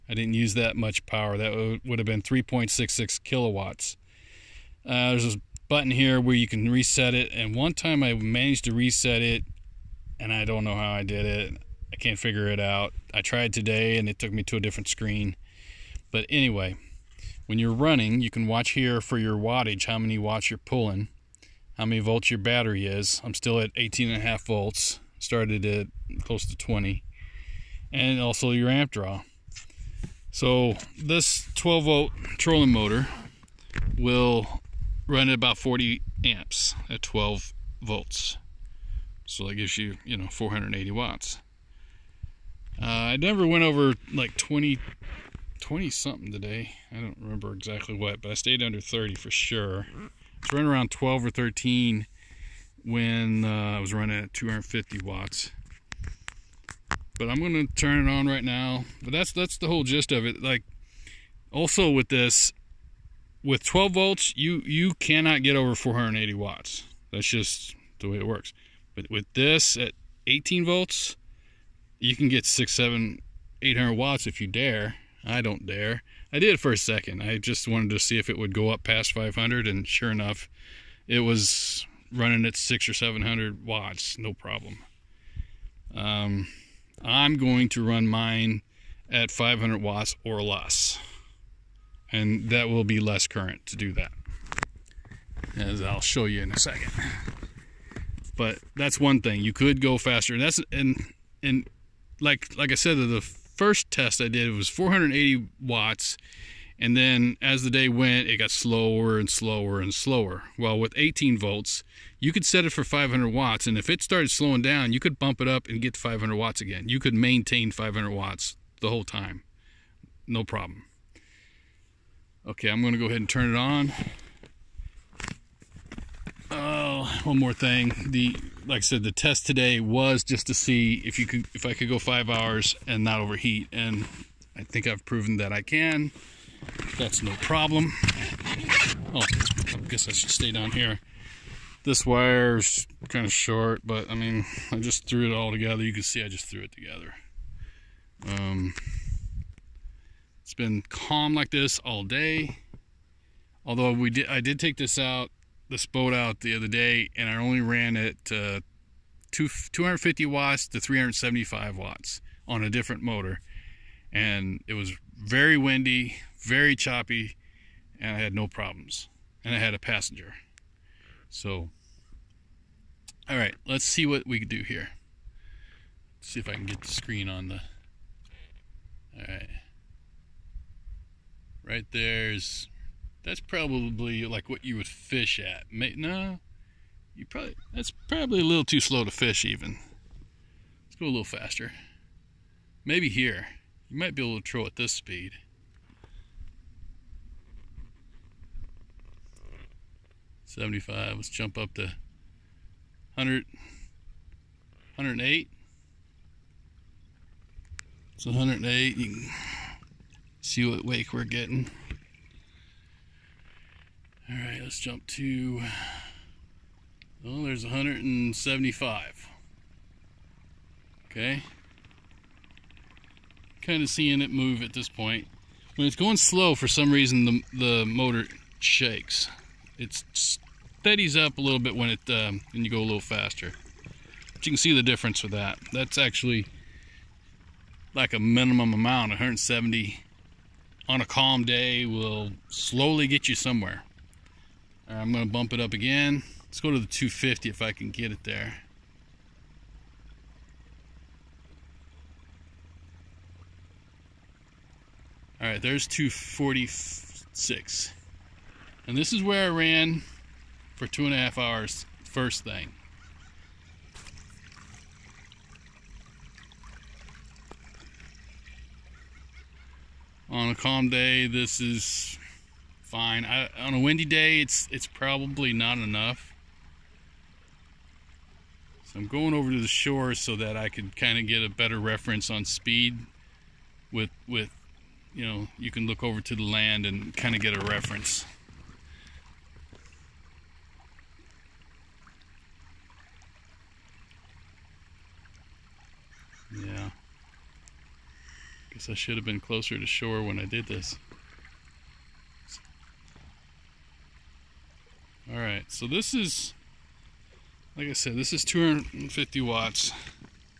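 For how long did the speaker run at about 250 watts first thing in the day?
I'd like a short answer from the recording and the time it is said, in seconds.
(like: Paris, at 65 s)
2.5 hours, at 260 s.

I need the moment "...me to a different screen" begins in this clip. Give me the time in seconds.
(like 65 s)
14 s.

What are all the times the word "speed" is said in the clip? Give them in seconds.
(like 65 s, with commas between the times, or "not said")
194 s, 282 s.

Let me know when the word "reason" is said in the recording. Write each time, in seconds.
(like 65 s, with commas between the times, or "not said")
226 s.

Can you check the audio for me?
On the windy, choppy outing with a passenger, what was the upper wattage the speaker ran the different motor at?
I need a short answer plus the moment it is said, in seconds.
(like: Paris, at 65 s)
375 watts, at 160 s.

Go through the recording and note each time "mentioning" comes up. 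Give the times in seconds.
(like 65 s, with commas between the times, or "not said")
not said.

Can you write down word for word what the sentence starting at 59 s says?
But that's that's the whole gist of it.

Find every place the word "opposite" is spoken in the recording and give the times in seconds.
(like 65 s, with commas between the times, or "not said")
not said.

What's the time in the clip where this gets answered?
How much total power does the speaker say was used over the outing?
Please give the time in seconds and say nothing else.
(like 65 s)
2 s.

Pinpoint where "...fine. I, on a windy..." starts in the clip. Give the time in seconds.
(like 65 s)
272 s.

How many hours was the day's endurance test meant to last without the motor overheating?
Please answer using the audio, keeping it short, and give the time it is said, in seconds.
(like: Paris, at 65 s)
5 hours, at 131 s.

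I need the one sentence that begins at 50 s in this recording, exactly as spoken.
It's running around 12 or 13 when uh, I was running at 250 watts.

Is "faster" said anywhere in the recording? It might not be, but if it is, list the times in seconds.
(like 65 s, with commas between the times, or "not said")
99 s, 191 s, 232 s.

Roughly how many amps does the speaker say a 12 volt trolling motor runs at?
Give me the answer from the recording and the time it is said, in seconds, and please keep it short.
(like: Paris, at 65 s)
40 amps, at 35 s.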